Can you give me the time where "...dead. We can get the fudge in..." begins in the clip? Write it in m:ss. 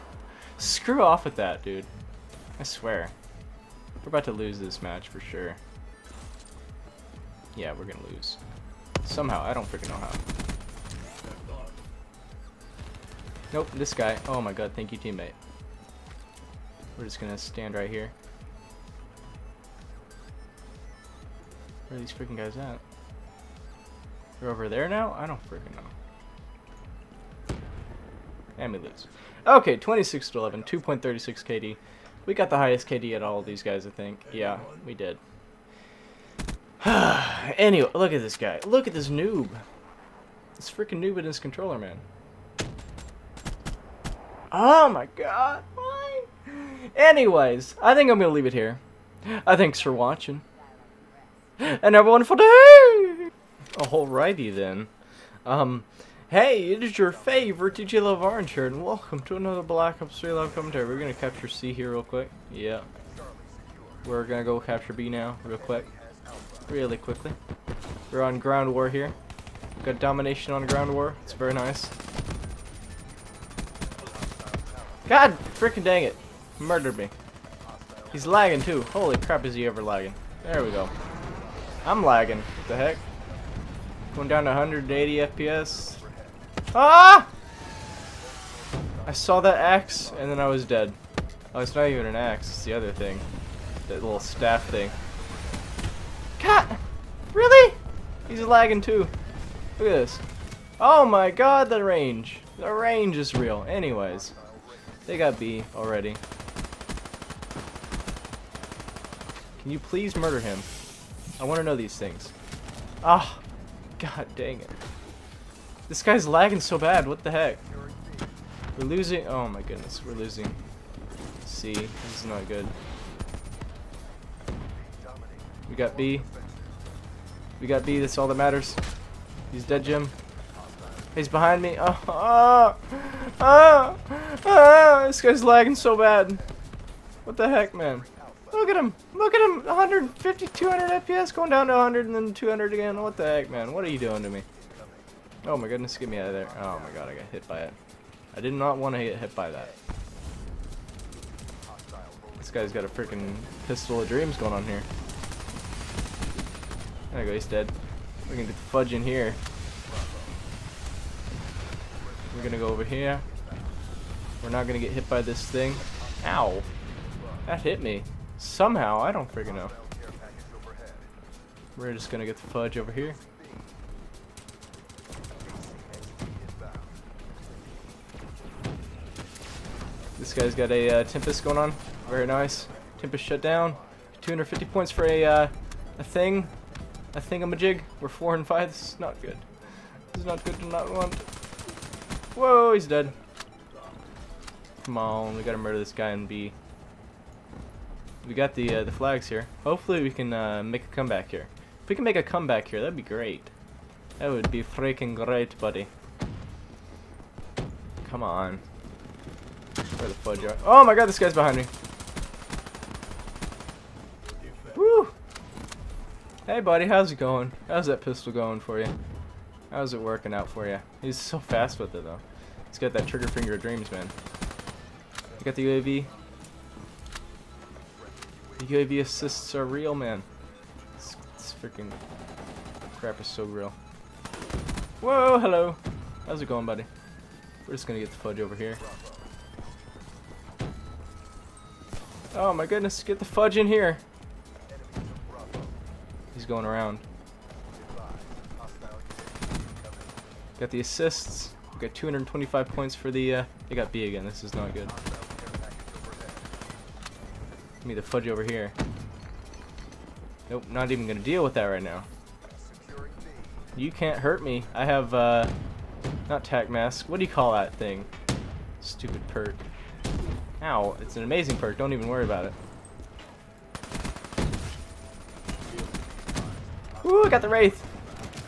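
2:37.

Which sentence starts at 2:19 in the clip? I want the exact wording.
150, 200 FPS going down to 100 and then 200 again.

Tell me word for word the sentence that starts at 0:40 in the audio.
This freaking noob in his controller, man.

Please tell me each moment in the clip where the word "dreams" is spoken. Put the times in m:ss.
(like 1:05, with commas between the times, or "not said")
2:34, 3:43.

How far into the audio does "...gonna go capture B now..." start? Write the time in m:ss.
1:04.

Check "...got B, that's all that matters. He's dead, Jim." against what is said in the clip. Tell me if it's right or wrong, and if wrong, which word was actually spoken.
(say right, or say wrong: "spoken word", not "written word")
right.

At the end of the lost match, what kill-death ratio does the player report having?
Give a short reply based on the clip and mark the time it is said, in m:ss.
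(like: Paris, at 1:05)
2.36, at 0:30.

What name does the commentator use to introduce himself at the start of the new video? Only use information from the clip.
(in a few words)
DJ Love Orange.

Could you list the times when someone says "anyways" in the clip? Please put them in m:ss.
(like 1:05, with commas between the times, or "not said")
0:36, 0:46, 1:43.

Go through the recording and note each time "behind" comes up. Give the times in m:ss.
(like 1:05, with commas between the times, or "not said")
2:11, 3:31.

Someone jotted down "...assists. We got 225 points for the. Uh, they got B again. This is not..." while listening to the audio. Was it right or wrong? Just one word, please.
right.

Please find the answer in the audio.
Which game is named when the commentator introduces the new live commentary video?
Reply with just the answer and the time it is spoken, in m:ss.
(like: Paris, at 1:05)
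Black Ops 3, at 0:59.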